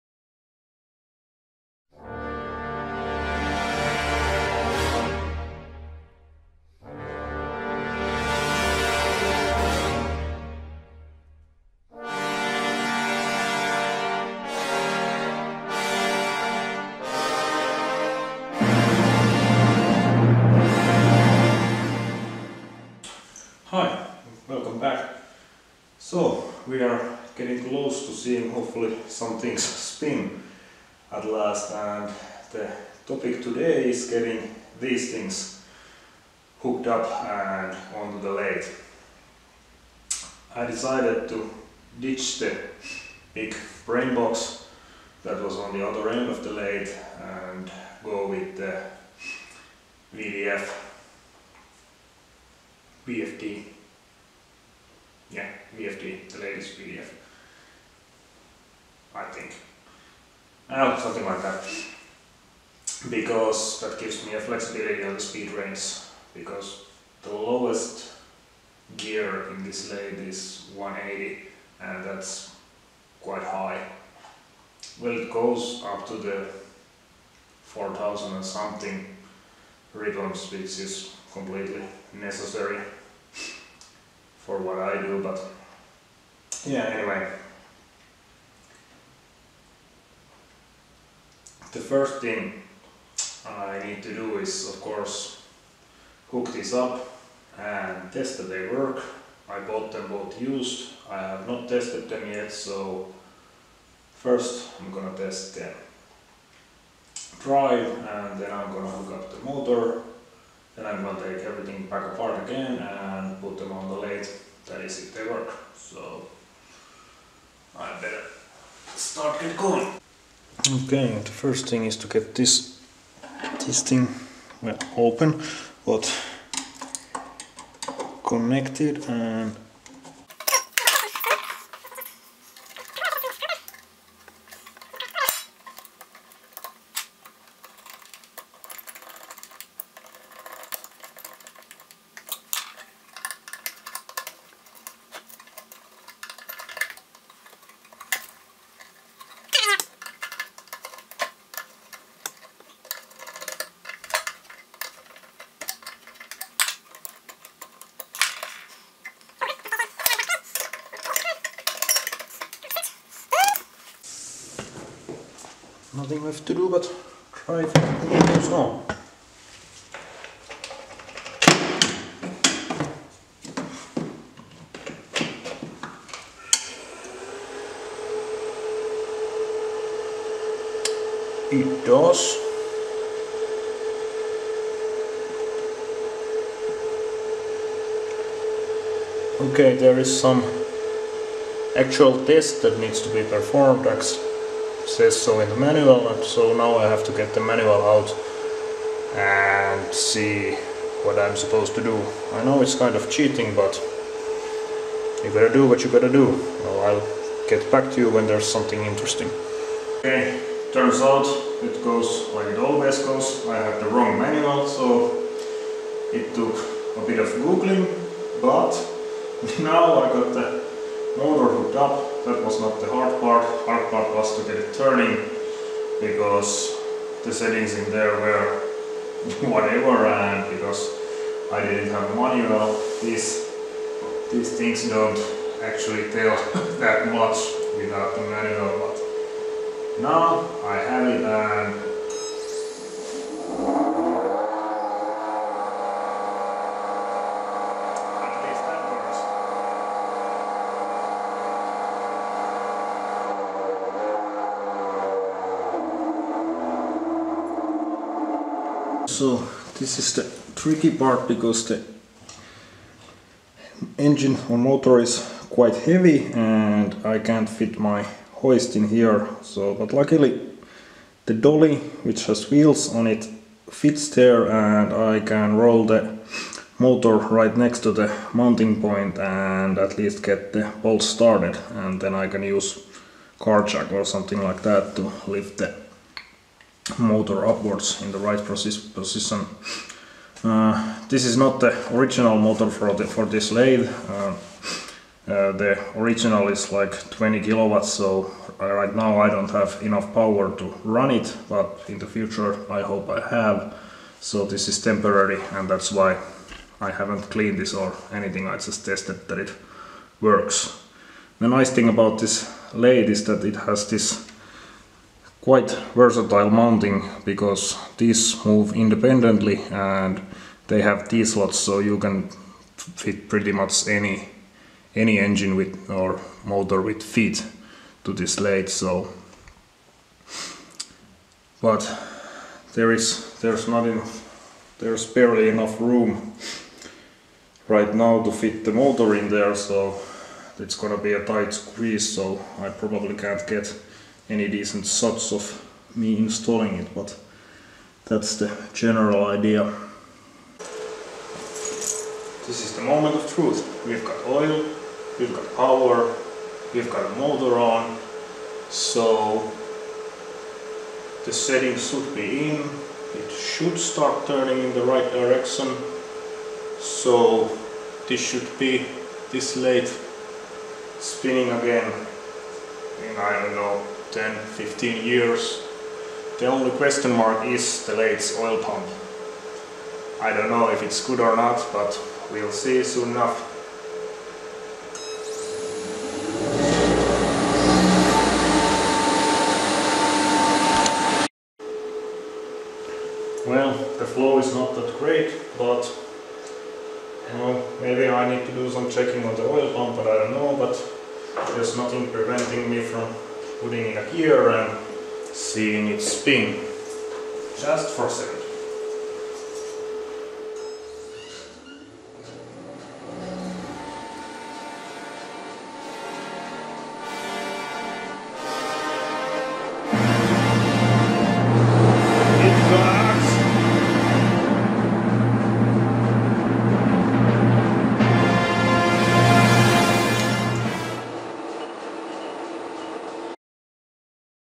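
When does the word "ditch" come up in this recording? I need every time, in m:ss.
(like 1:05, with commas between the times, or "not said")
0:41.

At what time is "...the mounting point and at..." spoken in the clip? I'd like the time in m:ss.
4:37.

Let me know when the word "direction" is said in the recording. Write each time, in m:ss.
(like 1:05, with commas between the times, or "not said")
6:05.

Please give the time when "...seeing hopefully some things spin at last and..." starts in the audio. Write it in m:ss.
0:28.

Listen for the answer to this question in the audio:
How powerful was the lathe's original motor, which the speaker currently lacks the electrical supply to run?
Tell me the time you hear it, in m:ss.
4:57.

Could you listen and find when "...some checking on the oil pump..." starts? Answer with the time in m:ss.
6:38.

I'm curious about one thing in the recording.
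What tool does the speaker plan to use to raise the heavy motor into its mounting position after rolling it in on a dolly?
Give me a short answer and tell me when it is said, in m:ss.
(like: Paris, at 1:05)
car jack, at 4:43.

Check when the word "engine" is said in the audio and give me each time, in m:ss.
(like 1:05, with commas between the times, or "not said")
4:23, 5:25.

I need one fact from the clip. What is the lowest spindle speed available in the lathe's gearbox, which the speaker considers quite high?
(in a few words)
180.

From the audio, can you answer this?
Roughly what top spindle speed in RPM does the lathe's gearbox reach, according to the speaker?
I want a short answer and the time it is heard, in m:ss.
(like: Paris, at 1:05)
4000 and something, at 1:17.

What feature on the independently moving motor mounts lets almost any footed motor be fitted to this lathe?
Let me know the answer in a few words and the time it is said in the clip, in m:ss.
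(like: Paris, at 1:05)
T-slots, at 5:21.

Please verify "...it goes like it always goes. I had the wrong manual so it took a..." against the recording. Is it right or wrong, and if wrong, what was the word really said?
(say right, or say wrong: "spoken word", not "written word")
right.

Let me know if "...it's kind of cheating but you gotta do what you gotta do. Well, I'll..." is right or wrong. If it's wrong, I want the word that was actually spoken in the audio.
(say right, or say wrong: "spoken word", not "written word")
right.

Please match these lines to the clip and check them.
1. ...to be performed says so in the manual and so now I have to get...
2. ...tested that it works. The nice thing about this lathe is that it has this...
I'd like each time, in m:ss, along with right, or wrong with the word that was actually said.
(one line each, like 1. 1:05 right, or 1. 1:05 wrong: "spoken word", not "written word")
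1. 3:13 right
2. 5:08 right.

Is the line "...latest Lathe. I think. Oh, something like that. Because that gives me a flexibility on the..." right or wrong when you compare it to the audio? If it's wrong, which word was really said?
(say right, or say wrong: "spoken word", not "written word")
wrong: "PDF", not "Lathe".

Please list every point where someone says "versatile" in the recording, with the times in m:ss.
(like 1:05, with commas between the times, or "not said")
5:15.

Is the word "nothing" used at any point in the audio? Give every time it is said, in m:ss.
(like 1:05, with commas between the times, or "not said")
2:45, 6:41.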